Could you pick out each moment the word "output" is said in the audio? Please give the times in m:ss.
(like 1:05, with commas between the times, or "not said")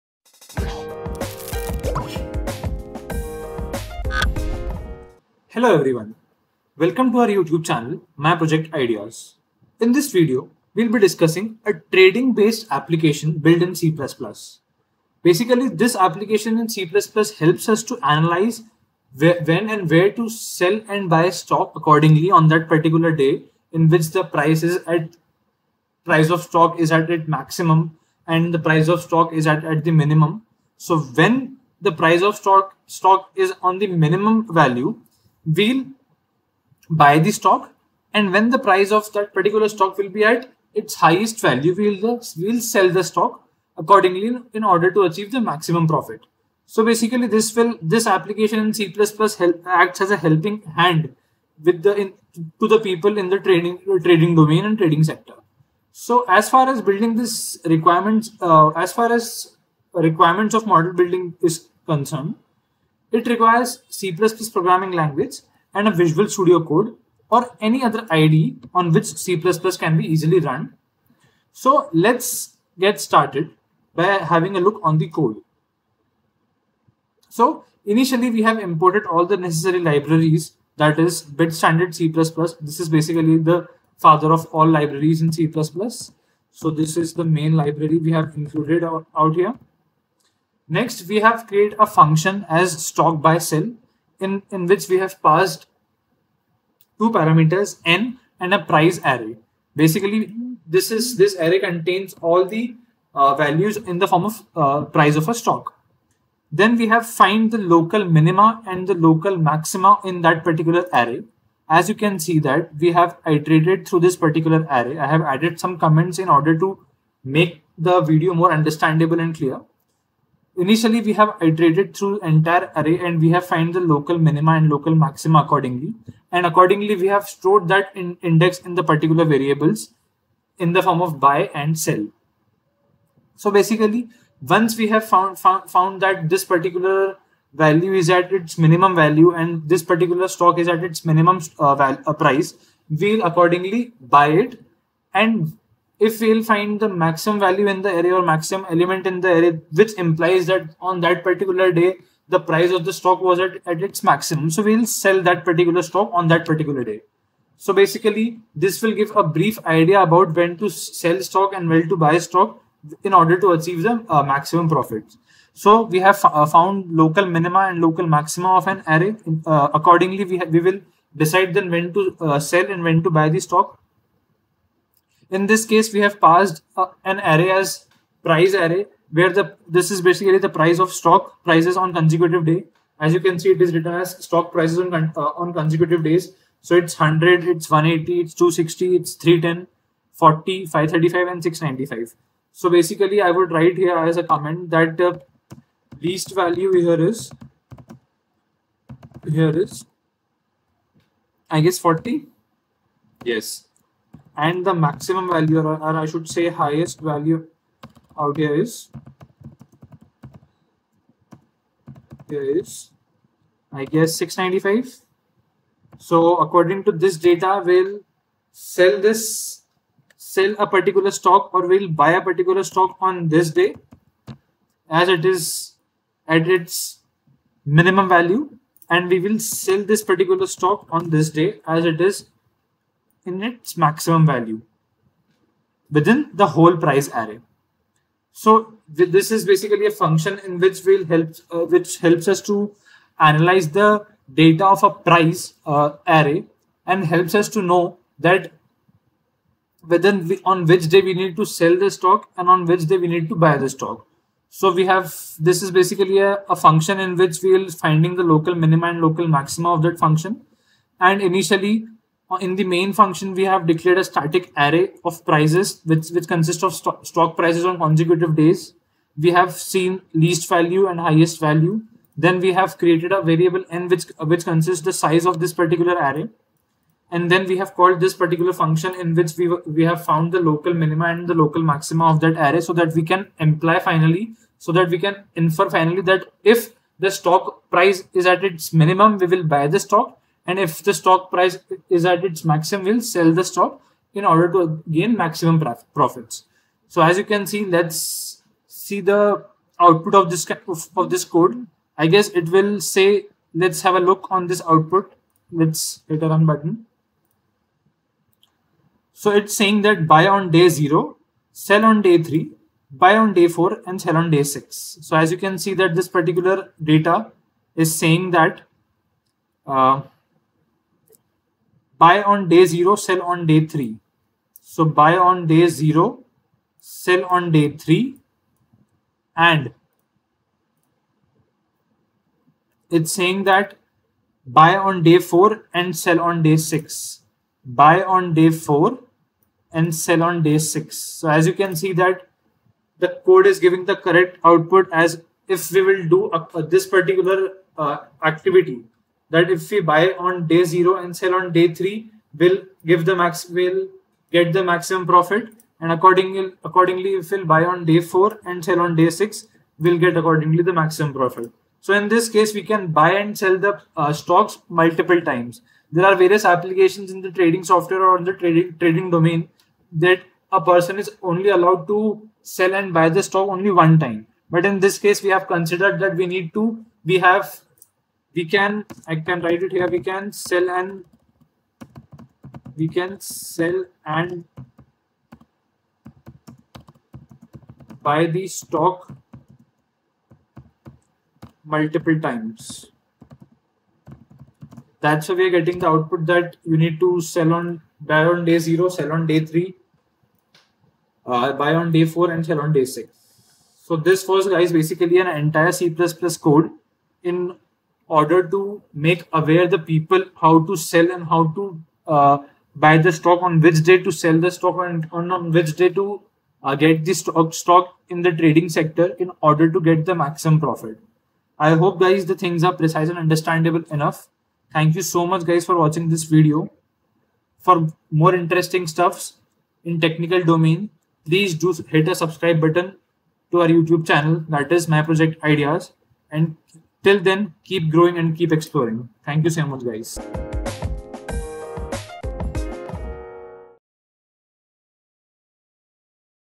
4:59, 5:04, 5:44, 6:35.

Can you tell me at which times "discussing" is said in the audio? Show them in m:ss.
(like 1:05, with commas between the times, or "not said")
0:10.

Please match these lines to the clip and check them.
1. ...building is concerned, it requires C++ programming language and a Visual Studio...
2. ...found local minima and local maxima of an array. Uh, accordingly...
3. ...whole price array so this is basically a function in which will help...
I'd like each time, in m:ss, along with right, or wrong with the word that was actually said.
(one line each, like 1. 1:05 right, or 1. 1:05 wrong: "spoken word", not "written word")
1. 1:00 right
2. 2:46 right
3. 3:56 right.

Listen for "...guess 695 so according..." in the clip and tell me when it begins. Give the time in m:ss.
3:33.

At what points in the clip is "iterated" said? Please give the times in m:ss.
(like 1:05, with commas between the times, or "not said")
1:53, 2:01.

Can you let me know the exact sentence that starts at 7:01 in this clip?
I hope guys the things are precise and understandable enough.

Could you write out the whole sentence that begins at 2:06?
And accordingly, we have stored that in index in the particular variables in the form of buy and sell.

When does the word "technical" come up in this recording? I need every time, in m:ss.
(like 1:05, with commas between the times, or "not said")
7:10.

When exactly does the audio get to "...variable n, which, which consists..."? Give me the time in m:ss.
4:33.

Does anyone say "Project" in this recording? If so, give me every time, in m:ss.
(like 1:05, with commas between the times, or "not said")
0:08, 7:15.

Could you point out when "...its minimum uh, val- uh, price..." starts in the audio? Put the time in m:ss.
2:20.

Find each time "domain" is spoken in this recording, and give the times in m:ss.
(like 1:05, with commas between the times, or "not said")
0:54, 6:09, 7:10.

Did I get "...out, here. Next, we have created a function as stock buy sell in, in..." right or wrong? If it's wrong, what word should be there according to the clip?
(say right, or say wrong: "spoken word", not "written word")
right.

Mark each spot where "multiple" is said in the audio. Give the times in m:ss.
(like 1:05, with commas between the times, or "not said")
6:04, 6:31.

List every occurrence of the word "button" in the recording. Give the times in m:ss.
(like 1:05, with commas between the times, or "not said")
5:06, 7:12.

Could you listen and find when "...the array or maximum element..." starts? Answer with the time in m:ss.
2:27.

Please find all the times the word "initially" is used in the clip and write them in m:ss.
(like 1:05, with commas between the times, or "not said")
1:17, 2:00, 4:21.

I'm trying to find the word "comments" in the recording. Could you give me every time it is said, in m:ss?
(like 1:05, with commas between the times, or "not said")
1:55, 3:14.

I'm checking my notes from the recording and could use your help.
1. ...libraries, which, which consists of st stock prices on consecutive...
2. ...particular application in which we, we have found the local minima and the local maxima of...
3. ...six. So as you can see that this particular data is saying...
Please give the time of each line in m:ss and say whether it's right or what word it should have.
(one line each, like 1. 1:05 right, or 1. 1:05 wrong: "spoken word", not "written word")
1. 4:25 wrong: "prices", not "libraries"
2. 4:38 wrong: "function", not "application"
3. 5:14 right.